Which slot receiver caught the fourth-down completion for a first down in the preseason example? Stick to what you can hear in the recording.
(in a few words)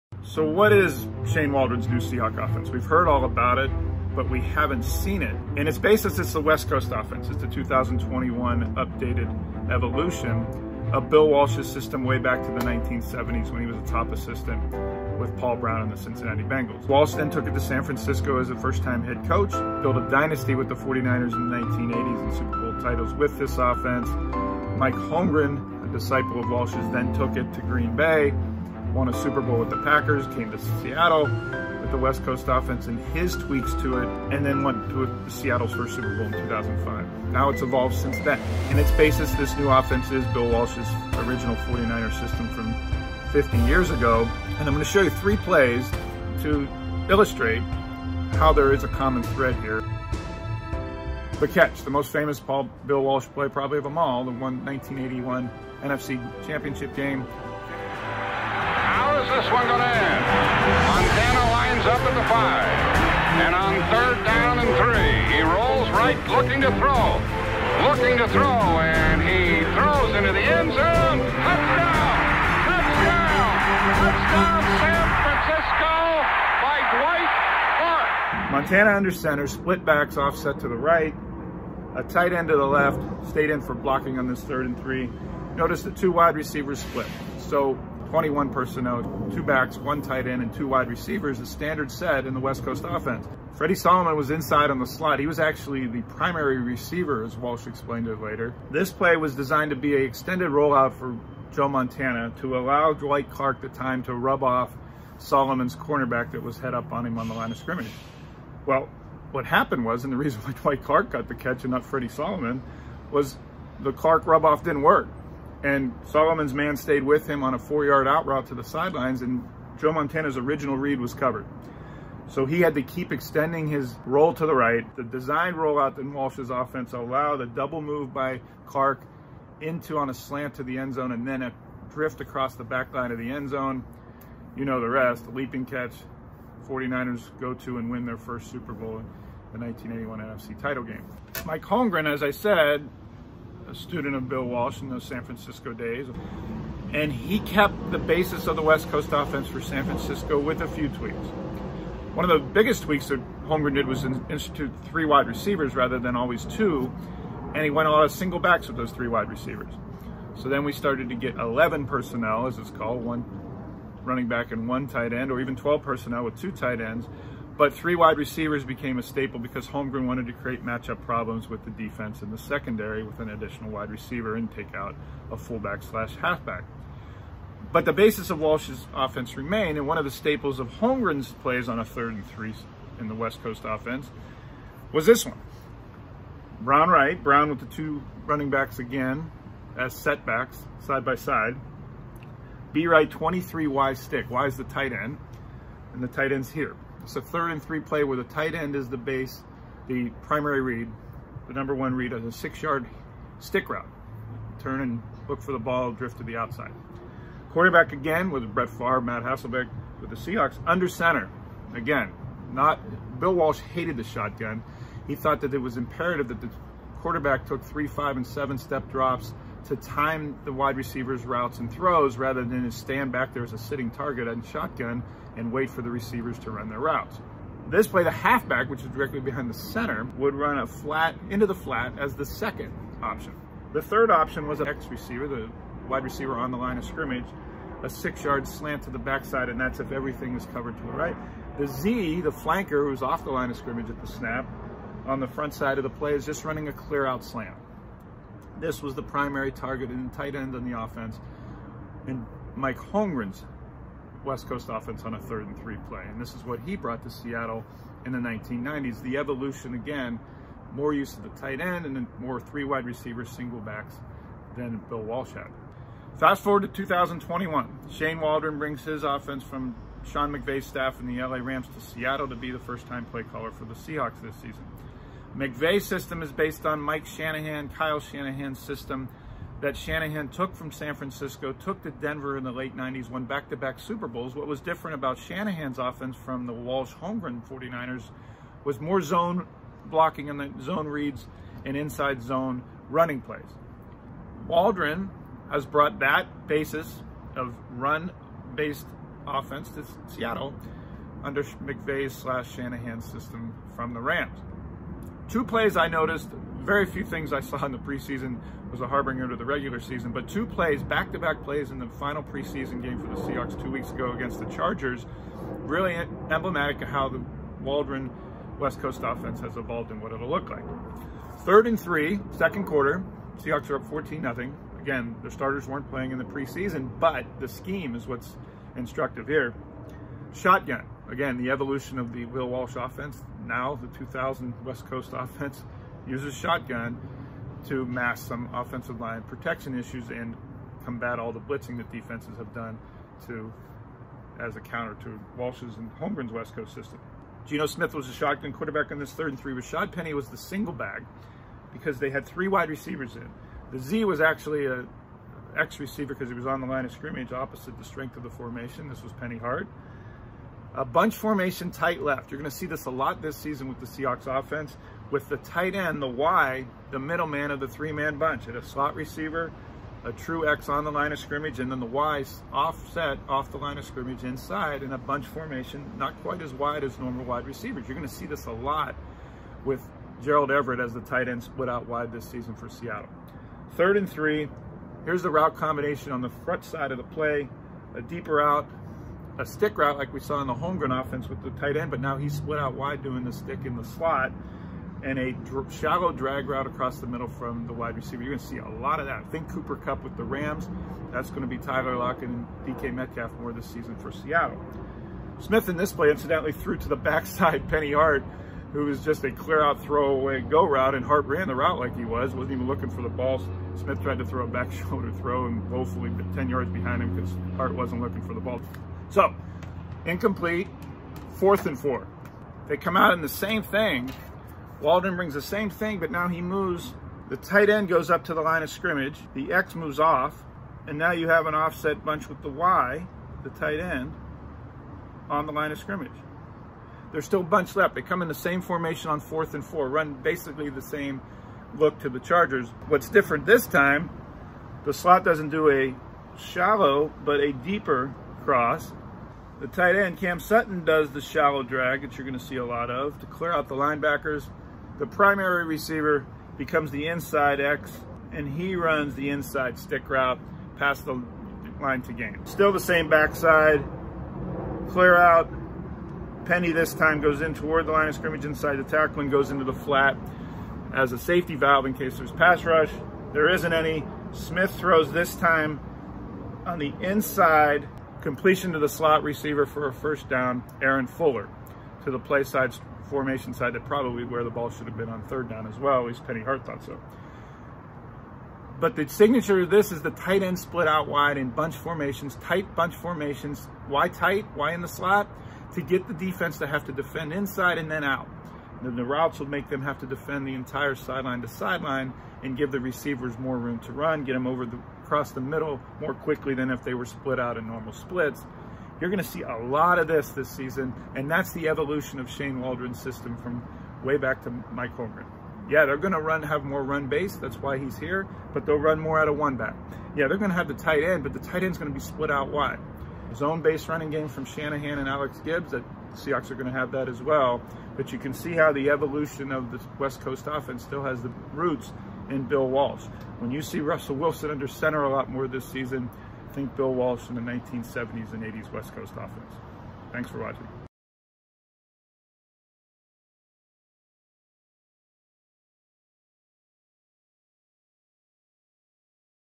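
Aaron Fuller.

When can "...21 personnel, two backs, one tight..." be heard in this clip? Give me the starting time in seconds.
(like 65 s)
88 s.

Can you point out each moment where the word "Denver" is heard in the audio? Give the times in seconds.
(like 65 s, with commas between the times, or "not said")
281 s.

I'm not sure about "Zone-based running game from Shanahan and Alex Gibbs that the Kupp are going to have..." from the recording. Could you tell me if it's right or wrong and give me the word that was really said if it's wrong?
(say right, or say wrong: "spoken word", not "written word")
wrong: "Seahawks", not "Kupp".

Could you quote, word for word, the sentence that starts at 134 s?
You know the rest, leaping catch.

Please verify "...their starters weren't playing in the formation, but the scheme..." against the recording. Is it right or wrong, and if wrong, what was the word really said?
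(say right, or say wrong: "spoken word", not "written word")
wrong: "preseason", not "formation".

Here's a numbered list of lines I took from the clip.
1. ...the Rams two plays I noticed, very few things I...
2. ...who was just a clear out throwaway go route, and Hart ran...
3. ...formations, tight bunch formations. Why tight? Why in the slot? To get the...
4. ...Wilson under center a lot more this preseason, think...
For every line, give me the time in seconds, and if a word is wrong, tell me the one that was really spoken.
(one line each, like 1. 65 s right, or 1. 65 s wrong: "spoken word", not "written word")
1. 303 s right
2. 408 s right
3. 491 s right
4. 534 s wrong: "season", not "preseason".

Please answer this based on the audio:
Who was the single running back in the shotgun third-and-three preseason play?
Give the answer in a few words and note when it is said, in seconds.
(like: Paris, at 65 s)
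Rashaad Penny, at 349 s.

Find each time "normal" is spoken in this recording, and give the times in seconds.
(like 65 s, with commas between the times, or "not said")
376 s, 507 s.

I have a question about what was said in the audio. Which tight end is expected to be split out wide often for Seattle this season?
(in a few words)
Gerald Everett.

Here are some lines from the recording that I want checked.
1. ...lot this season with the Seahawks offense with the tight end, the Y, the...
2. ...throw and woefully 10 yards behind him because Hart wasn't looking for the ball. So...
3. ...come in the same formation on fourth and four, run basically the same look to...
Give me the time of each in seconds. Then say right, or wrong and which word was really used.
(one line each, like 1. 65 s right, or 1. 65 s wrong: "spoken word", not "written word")
1. 362 s right
2. 415 s right
3. 438 s right.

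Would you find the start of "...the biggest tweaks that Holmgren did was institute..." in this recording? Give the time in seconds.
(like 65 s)
152 s.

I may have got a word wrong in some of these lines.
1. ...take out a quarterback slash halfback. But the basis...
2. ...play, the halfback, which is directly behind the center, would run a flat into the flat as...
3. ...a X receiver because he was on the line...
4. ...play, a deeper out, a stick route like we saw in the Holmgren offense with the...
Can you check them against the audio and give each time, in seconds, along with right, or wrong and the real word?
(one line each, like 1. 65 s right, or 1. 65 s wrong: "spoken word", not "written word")
1. 174 s wrong: "fullback", not "quarterback"
2. 227 s right
3. 354 s right
4. 387 s right.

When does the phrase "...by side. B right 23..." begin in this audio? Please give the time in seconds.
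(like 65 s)
191 s.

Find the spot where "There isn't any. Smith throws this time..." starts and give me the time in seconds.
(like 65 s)
473 s.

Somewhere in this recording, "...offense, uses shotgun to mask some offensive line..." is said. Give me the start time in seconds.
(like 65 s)
335 s.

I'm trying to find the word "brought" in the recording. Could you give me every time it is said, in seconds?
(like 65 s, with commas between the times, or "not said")
256 s, 295 s.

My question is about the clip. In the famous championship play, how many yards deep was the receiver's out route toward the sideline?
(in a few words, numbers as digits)
4.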